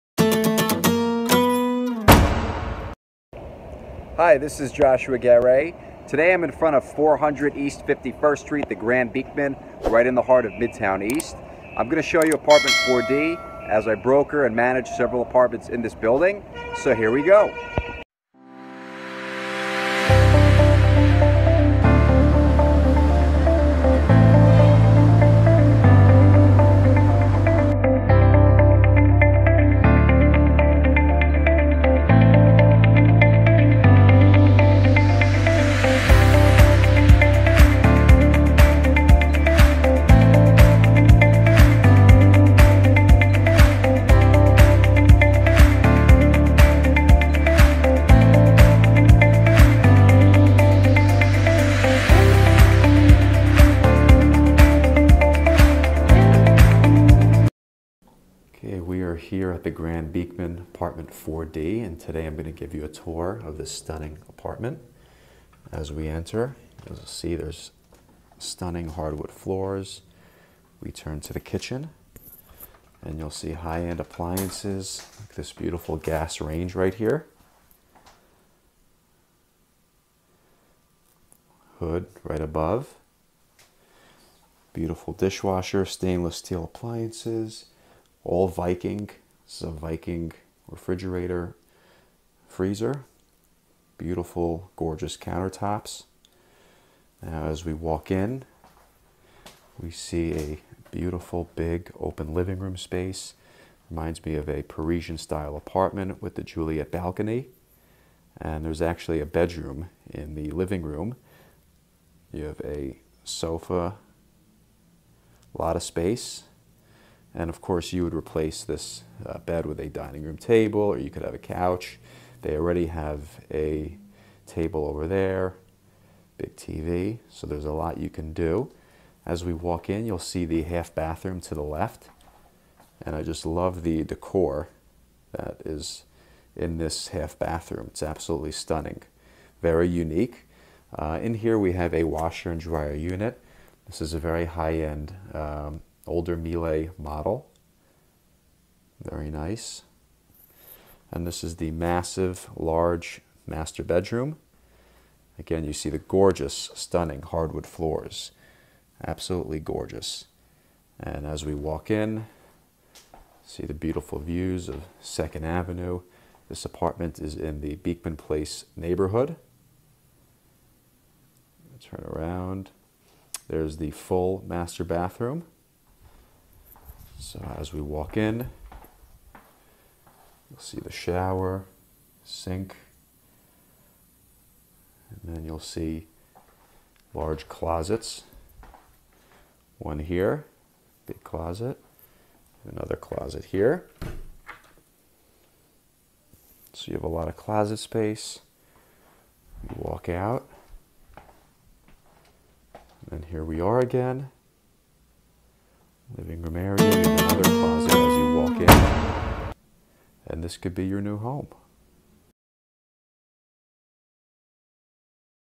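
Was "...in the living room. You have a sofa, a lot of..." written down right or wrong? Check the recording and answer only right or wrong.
right.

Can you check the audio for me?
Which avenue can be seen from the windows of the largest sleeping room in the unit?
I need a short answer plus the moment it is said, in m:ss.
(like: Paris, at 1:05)
2nd Avenue, at 2:45.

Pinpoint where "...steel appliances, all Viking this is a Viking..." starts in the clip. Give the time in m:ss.
1:26.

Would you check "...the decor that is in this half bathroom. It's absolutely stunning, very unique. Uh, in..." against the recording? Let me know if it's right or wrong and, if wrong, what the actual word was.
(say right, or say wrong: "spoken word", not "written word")
right.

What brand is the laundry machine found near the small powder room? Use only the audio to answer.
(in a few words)
Miele.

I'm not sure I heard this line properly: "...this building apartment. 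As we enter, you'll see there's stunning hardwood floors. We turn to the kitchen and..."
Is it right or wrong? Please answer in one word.
wrong.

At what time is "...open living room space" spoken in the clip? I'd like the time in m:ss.
1:41.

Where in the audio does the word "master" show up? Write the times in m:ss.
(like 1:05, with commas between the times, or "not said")
2:33, 2:54.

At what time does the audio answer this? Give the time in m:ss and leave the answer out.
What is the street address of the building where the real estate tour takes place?
0:06.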